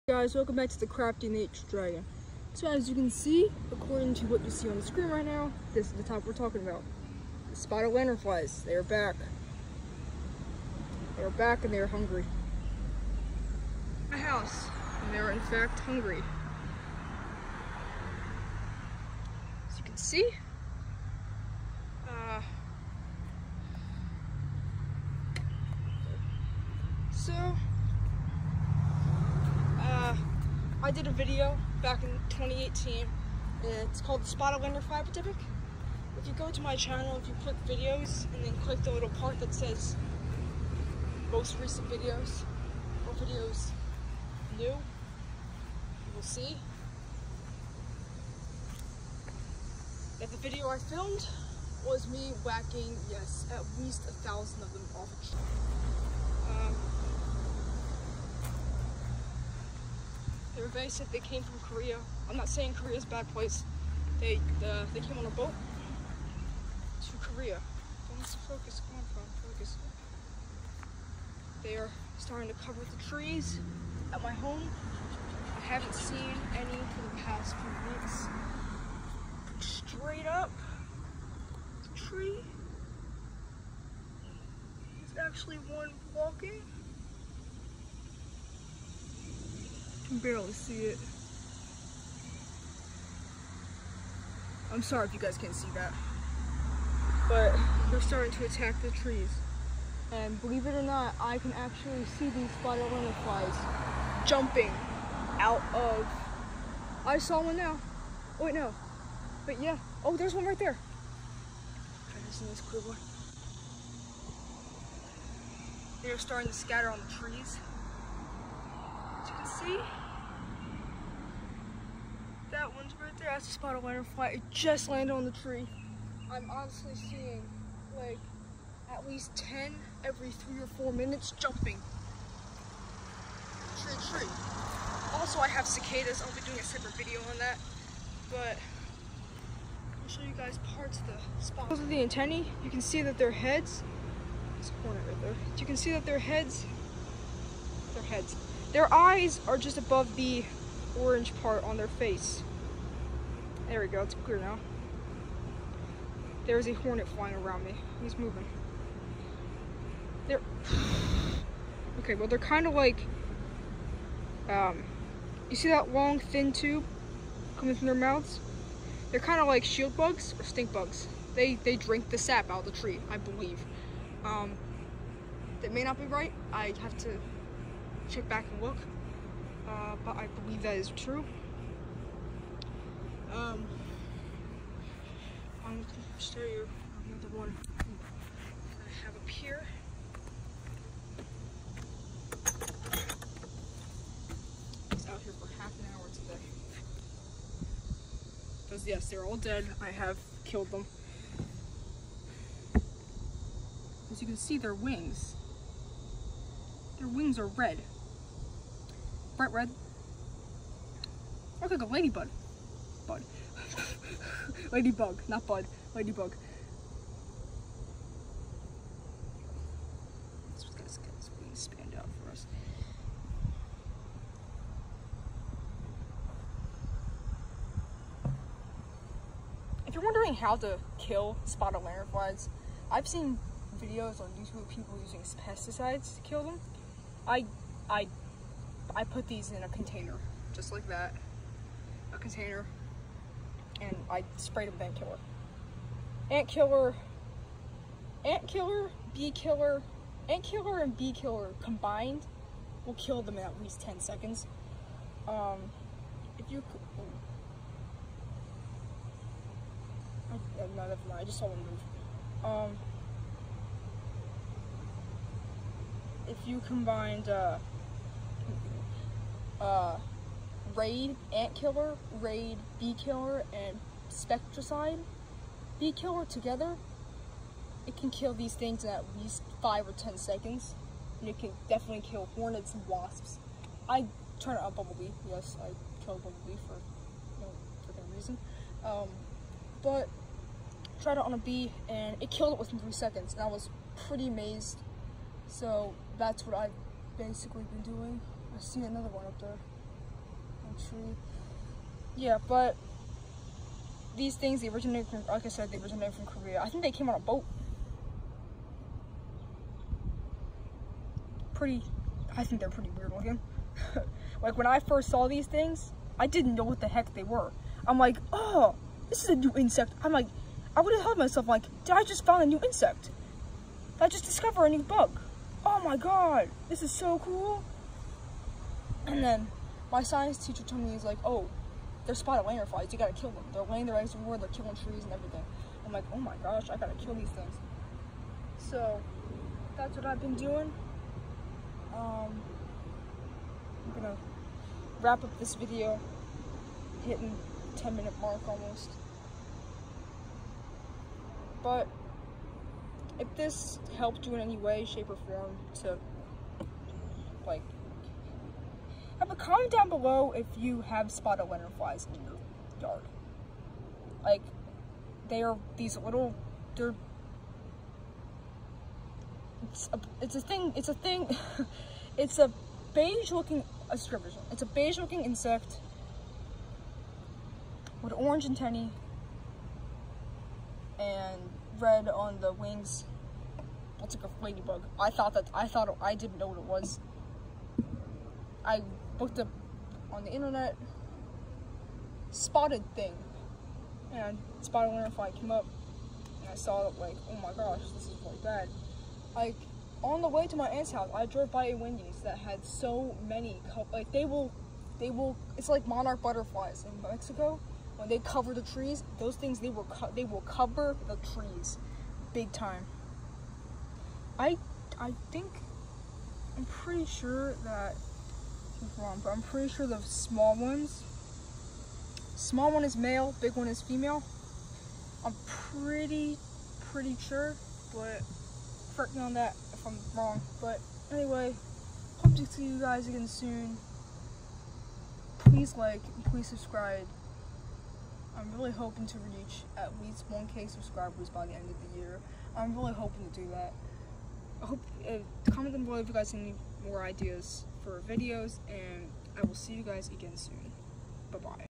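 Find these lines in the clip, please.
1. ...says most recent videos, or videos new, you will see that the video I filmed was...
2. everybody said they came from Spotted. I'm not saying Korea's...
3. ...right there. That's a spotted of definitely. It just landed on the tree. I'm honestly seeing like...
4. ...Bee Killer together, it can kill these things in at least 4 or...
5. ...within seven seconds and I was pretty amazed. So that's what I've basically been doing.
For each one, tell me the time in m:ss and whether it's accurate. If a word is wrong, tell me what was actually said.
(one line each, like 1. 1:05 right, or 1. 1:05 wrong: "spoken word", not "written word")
1. 0:39 right
2. 1:00 wrong: "Korea", not "Spotted"
3. 2:03 wrong: "butterfly", not "definitely"
4. 4:35 wrong: "5", not "4"
5. 4:52 wrong: "three", not "seven".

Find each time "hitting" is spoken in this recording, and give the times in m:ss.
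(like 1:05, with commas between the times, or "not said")
5:47.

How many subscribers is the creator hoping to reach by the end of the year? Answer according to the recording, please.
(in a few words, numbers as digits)
1k.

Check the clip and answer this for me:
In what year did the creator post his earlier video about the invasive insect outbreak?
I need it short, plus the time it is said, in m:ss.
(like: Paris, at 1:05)
2018, at 0:32.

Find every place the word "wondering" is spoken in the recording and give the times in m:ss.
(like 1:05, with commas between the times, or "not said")
3:50.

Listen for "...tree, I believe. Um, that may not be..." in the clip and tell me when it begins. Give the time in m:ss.
2:52.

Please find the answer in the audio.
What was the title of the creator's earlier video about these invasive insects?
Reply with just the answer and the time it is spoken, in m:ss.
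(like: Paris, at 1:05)
Spotted Lantern Fly Epidemic, at 0:34.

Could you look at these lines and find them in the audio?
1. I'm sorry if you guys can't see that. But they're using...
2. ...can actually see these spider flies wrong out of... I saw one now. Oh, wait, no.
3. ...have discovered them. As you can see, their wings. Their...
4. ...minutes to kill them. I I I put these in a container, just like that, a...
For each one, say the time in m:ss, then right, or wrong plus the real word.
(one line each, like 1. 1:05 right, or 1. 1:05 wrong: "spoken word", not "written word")
1. 1:34 wrong: "starting", not "using"
2. 1:41 wrong: "jumping", not "wrong"
3. 3:19 wrong: "killed", not "discovered"
4. 3:55 wrong: "pesticides", not "minutes".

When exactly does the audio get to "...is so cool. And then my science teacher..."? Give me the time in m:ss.
5:26.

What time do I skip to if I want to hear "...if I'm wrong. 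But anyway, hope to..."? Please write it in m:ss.
7:09.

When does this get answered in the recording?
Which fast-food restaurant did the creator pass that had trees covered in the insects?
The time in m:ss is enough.
6:41.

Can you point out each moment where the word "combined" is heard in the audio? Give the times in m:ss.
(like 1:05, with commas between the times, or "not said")
4:11, 4:26.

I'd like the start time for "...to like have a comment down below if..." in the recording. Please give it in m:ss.
5:55.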